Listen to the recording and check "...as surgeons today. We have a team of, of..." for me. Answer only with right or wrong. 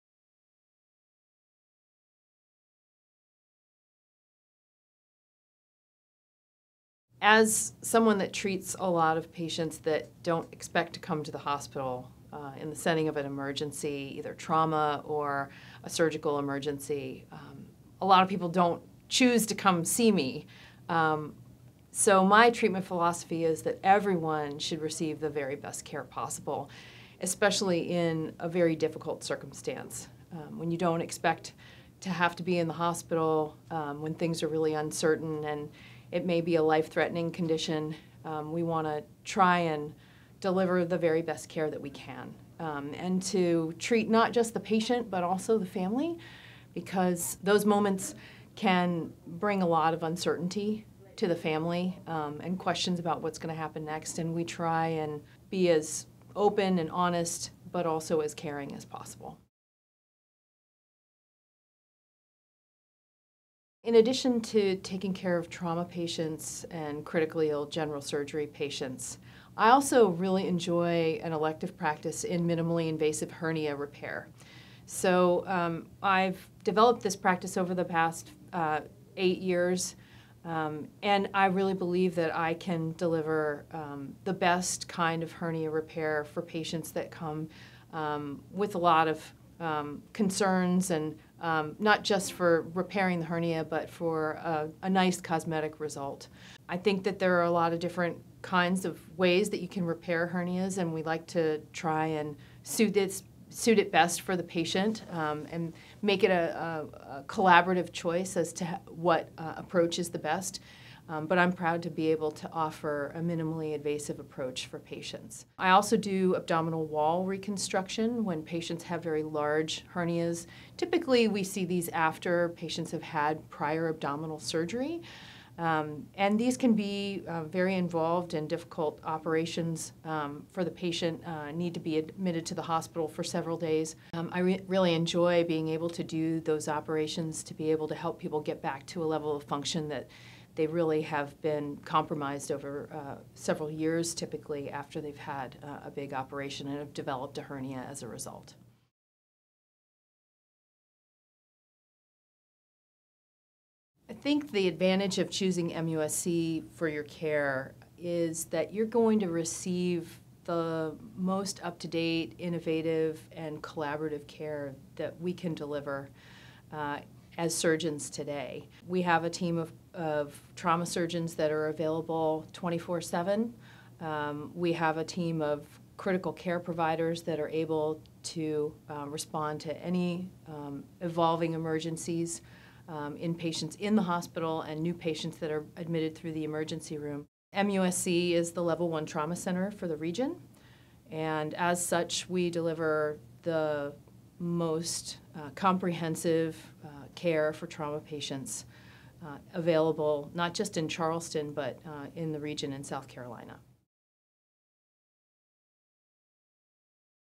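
right.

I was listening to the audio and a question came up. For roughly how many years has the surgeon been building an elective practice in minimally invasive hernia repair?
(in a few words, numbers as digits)
8.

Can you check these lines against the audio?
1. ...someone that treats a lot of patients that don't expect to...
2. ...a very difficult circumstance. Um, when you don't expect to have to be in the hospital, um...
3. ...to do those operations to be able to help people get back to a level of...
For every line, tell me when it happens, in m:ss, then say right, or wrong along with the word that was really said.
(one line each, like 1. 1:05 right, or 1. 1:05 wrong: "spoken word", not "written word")
1. 0:07 right
2. 0:28 right
3. 2:15 right.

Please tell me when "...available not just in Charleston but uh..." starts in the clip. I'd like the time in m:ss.
3:19.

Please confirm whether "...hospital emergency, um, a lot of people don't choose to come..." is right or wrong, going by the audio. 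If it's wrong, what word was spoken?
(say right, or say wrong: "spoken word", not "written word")
wrong: "surgical", not "hospital".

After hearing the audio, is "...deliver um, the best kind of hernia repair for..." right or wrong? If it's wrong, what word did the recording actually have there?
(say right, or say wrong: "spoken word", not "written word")
right.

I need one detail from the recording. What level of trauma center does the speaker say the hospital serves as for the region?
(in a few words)
Level 1.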